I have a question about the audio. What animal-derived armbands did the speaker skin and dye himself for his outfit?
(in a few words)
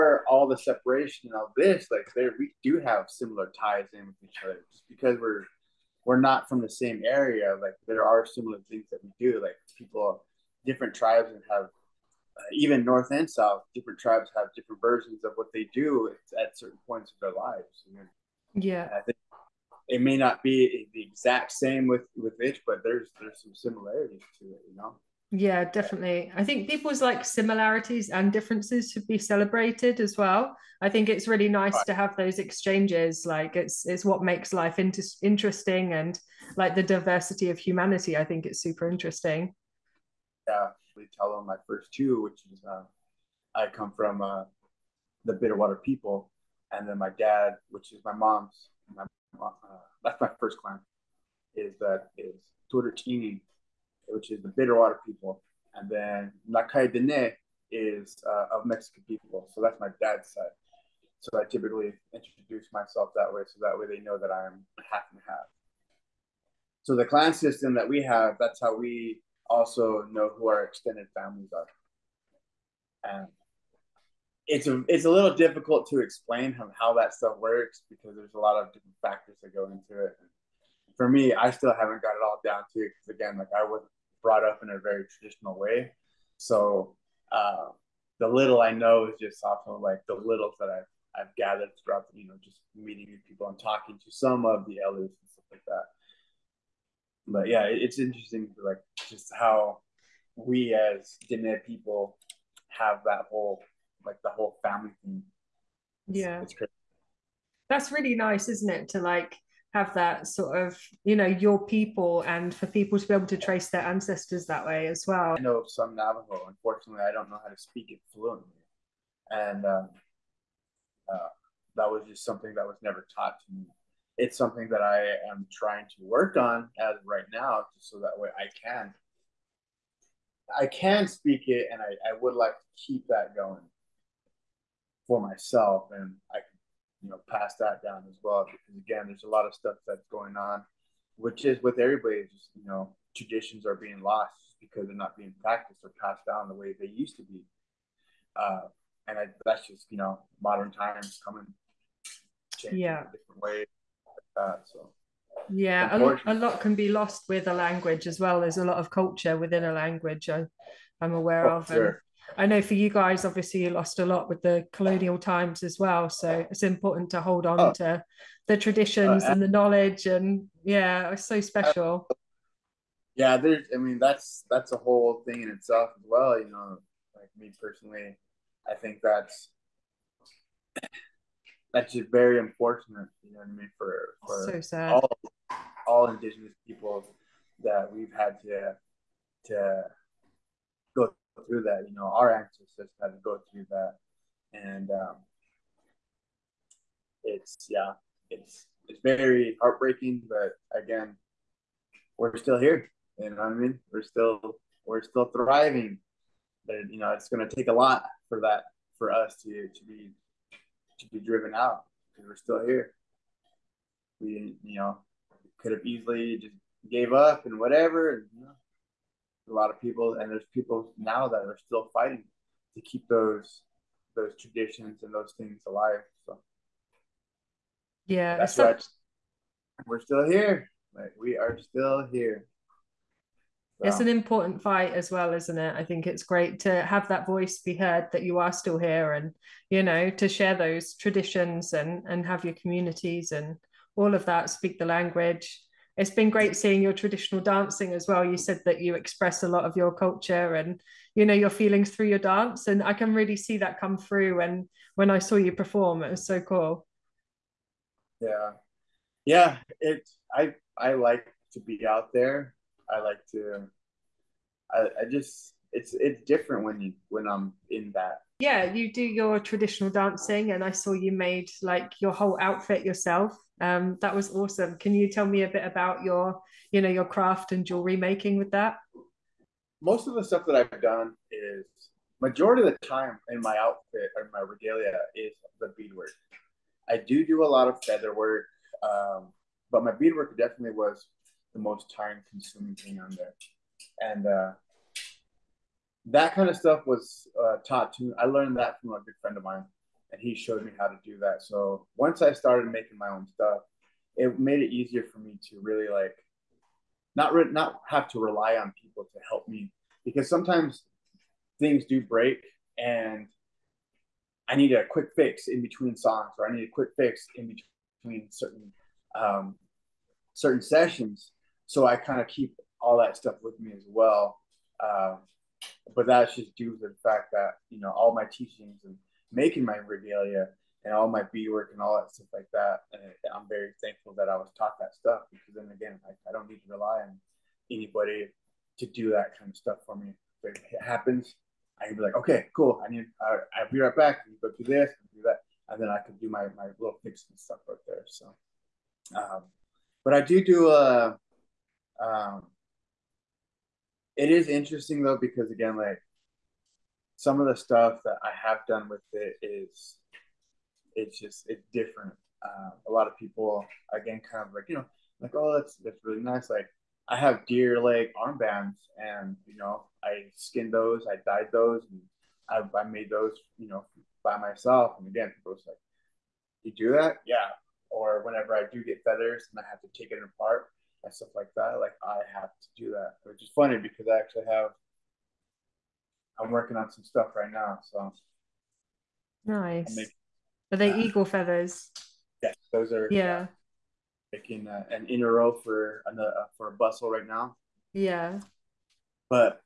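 Deer leg armbands.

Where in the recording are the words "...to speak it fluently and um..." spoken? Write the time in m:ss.
1:57.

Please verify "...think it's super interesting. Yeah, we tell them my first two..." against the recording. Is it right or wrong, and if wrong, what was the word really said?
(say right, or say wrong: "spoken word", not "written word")
right.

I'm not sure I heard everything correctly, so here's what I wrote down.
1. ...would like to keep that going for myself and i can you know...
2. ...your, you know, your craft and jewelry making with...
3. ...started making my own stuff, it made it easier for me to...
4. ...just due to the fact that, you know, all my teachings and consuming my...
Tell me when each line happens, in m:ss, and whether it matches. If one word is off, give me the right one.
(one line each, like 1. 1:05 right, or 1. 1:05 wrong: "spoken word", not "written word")
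1. 2:12 right
2. 4:36 right
3. 5:02 right
4. 5:26 wrong: "making", not "consuming".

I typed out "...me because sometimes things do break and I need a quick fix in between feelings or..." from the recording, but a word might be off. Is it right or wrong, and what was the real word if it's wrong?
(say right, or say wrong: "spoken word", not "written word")
wrong: "songs", not "feelings".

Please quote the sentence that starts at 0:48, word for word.
My, uh, that's my first clan.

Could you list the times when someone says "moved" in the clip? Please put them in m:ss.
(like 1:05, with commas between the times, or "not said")
not said.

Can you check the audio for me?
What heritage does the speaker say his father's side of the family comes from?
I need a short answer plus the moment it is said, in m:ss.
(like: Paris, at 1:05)
Mexican, at 0:58.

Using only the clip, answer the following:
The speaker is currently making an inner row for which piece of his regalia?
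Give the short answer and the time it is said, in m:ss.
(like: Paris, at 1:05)
A bustle, at 6:36.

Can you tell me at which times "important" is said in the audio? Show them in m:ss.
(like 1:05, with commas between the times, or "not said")
2:46, 3:54.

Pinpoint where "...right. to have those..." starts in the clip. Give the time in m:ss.
0:31.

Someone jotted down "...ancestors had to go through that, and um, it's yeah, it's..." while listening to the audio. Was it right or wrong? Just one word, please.
right.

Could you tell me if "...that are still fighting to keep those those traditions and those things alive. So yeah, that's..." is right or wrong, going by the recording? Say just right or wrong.
right.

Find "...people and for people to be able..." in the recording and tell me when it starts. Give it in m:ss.
1:51.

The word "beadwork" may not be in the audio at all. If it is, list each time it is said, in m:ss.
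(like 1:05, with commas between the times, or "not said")
4:45, 4:49, 5:31.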